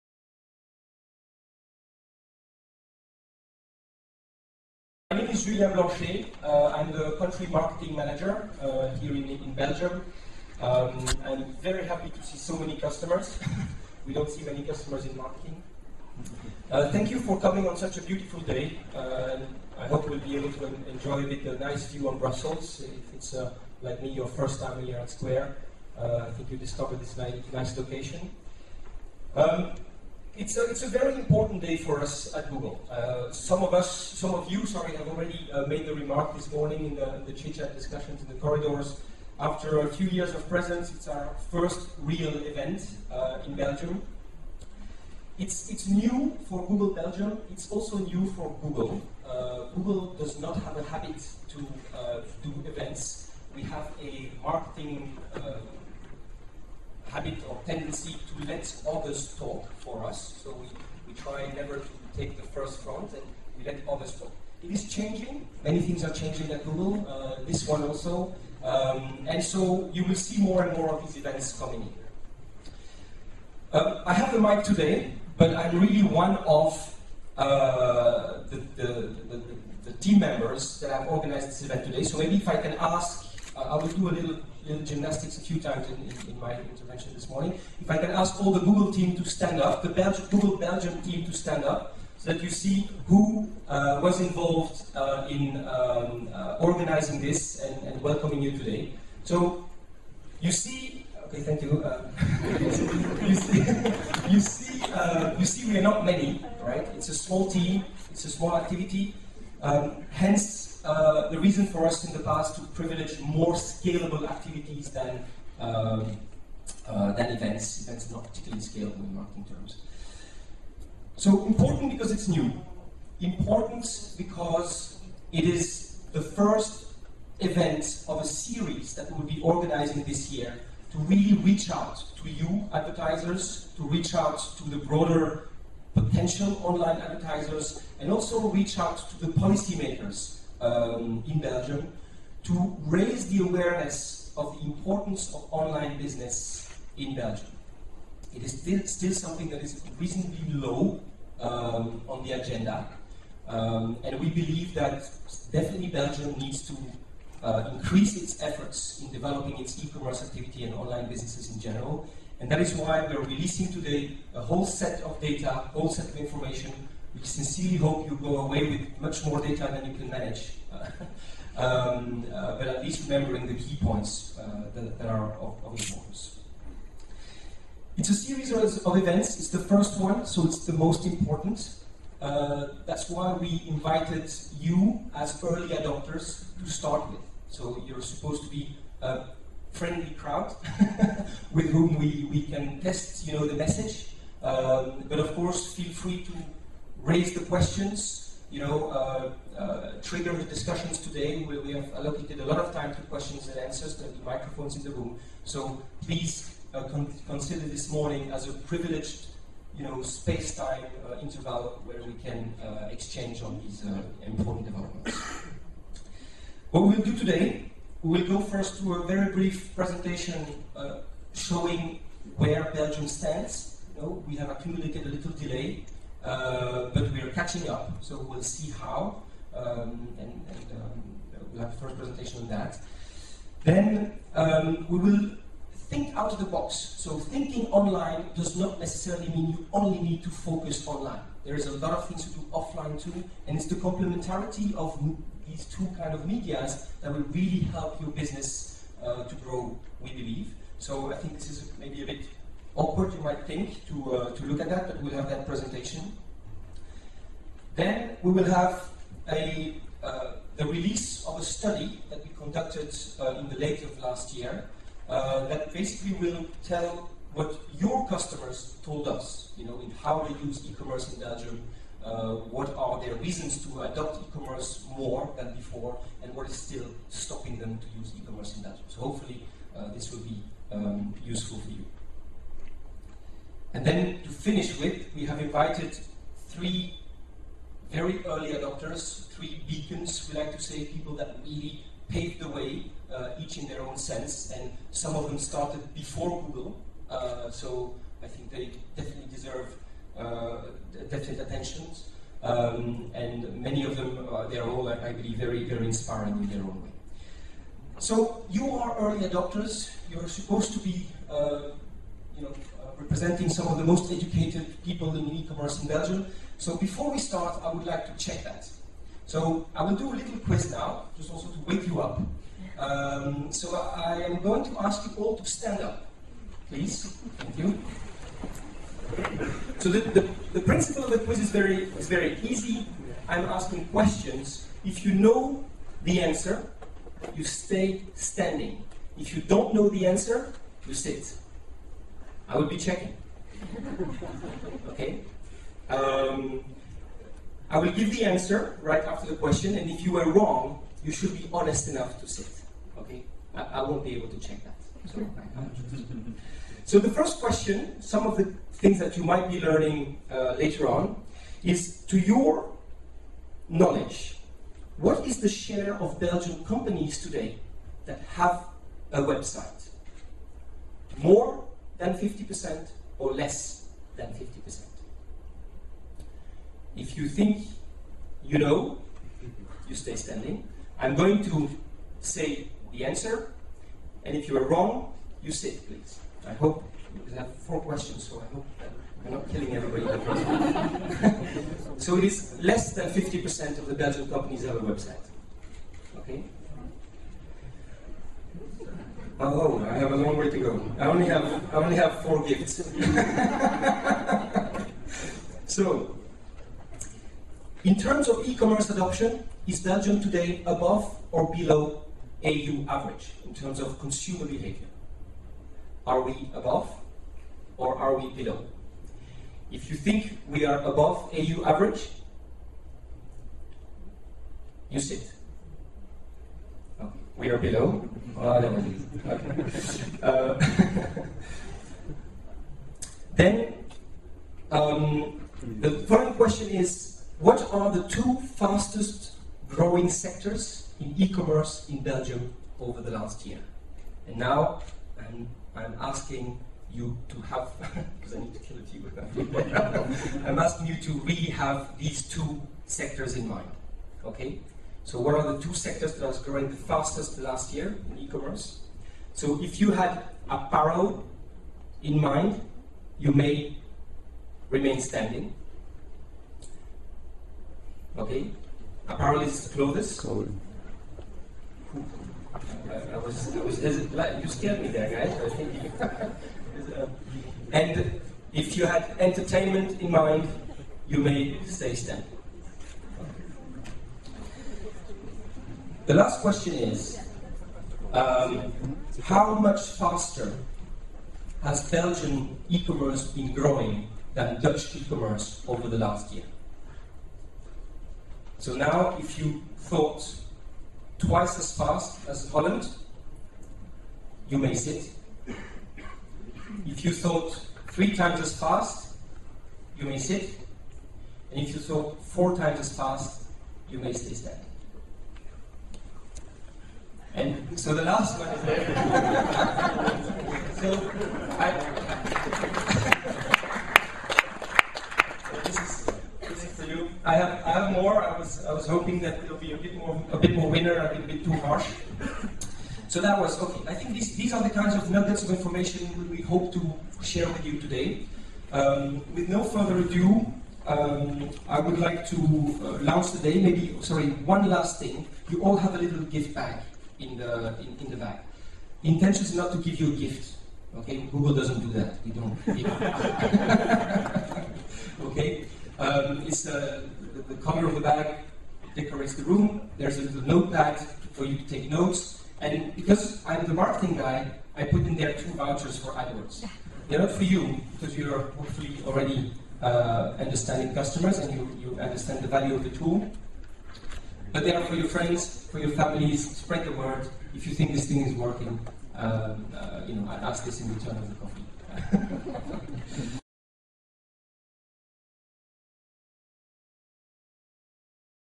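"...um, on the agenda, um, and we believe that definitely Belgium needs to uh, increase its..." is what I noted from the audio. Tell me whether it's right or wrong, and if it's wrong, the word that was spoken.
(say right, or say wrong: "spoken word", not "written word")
right.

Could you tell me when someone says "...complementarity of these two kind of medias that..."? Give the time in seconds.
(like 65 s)
243 s.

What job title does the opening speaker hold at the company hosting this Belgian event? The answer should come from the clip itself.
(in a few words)
Country marketing manager.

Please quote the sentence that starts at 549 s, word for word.
The intention is not to give you a gift.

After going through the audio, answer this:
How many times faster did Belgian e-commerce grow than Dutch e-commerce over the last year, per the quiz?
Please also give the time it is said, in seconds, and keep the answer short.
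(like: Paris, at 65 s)
4 times, at 512 s.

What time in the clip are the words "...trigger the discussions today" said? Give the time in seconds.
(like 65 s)
200 s.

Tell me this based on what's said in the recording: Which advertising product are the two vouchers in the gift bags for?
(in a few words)
AdWords.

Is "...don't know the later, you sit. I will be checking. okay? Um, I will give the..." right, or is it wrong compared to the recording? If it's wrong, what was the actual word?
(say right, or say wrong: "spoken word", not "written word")
wrong: "answer", not "later".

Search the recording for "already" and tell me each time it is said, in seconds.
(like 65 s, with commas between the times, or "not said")
35 s, 569 s.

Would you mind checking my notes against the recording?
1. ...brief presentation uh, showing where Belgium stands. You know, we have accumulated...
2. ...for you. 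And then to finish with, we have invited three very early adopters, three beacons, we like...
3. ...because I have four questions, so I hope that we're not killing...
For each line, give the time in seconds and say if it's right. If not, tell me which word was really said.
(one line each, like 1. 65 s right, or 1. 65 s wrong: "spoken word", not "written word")
1. 219 s right
2. 281 s right
3. 387 s right.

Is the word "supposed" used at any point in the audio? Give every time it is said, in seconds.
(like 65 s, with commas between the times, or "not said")
188 s, 310 s.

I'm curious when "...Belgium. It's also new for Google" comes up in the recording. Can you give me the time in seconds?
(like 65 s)
46 s.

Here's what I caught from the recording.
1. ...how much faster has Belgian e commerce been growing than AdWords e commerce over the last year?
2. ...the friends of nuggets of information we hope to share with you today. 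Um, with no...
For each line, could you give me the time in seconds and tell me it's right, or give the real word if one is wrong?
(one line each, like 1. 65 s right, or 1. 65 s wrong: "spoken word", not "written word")
1. 489 s wrong: "Dutch", not "AdWords"
2. 534 s wrong: "kinds", not "friends".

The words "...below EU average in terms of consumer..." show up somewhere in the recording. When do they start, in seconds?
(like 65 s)
411 s.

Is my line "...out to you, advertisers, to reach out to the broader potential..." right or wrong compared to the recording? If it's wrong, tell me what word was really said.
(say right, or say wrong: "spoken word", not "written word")
right.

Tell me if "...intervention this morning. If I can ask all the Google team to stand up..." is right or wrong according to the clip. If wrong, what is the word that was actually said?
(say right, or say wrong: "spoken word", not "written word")
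right.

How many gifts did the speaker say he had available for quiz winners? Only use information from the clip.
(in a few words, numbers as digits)
4.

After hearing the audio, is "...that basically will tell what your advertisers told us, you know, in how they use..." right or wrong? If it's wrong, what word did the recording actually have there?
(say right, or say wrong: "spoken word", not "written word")
wrong: "customers", not "advertisers".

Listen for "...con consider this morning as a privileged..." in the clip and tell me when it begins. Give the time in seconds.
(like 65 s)
206 s.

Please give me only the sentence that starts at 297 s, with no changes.
Uh, so I think they definitely deserve uh, definite attentions.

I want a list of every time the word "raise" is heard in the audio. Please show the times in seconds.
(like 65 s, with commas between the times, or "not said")
142 s, 197 s.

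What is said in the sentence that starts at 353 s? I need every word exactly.
Okay, I, I won't be able to check that.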